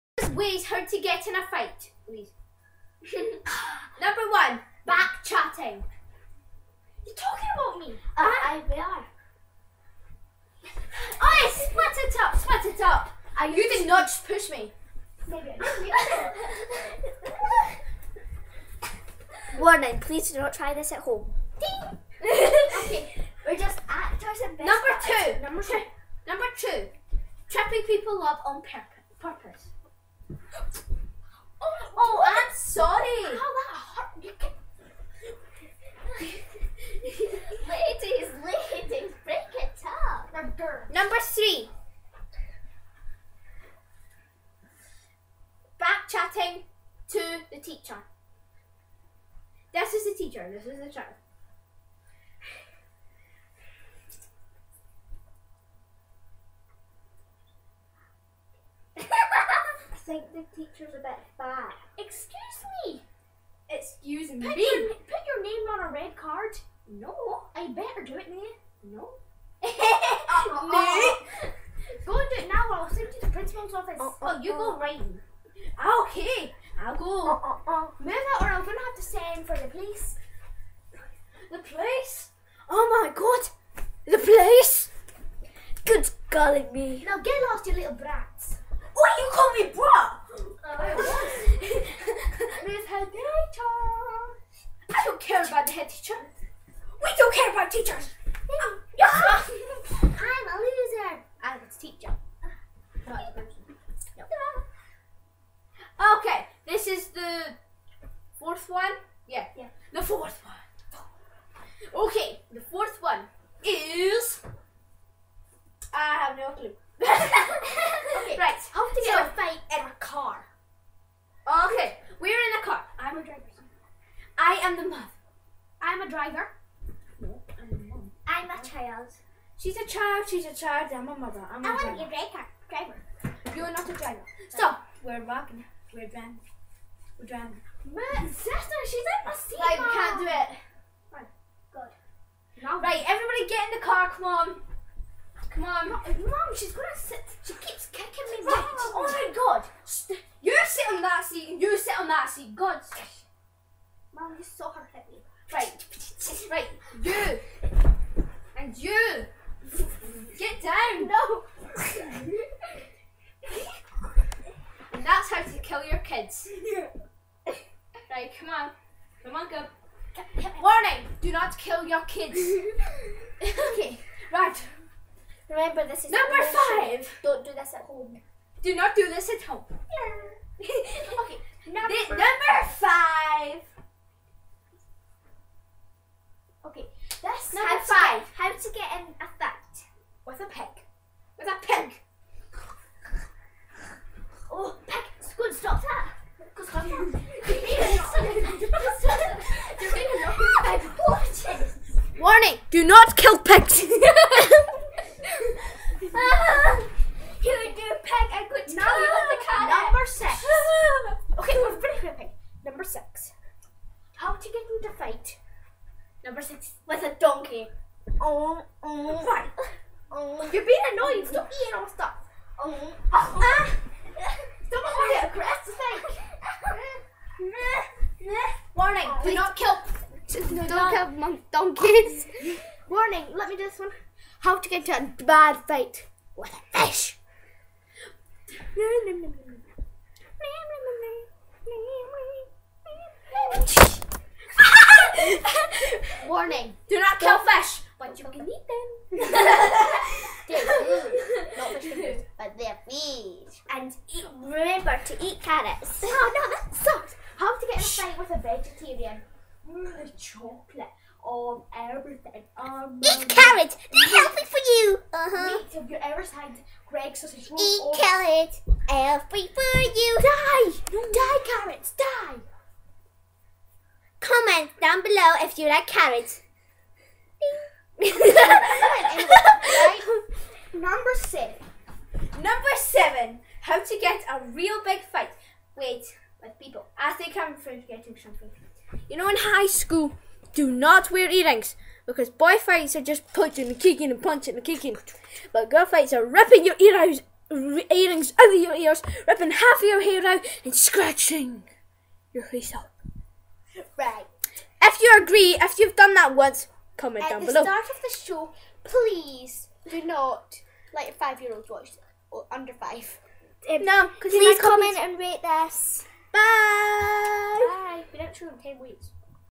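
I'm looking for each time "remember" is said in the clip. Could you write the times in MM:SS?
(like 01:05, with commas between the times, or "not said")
02:55, 04:14.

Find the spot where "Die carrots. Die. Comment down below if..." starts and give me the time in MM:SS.
04:30.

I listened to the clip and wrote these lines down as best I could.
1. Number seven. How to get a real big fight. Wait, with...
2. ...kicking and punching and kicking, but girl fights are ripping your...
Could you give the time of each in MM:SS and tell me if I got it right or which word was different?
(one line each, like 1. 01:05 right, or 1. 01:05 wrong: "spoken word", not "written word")
1. 04:42 right
2. 04:53 right.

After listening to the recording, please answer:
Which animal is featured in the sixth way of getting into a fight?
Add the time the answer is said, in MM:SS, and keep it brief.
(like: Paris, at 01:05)
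A donkey, at 03:37.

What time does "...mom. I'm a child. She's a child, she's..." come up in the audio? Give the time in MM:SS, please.
02:07.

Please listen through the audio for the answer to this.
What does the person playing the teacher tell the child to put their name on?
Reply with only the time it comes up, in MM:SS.
01:05.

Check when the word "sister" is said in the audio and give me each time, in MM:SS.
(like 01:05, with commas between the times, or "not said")
02:18.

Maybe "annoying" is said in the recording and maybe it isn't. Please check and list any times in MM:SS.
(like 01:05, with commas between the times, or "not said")
03:40.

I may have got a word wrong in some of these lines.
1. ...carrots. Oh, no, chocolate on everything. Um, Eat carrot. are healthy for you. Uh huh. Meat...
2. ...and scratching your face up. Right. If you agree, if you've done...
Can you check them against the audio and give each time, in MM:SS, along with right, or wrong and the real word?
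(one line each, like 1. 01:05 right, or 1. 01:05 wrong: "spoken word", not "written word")
1. 04:15 right
2. 05:00 right.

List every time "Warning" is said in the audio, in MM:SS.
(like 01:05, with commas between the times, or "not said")
00:19, 02:50, 03:22, 03:48, 03:52, 04:06.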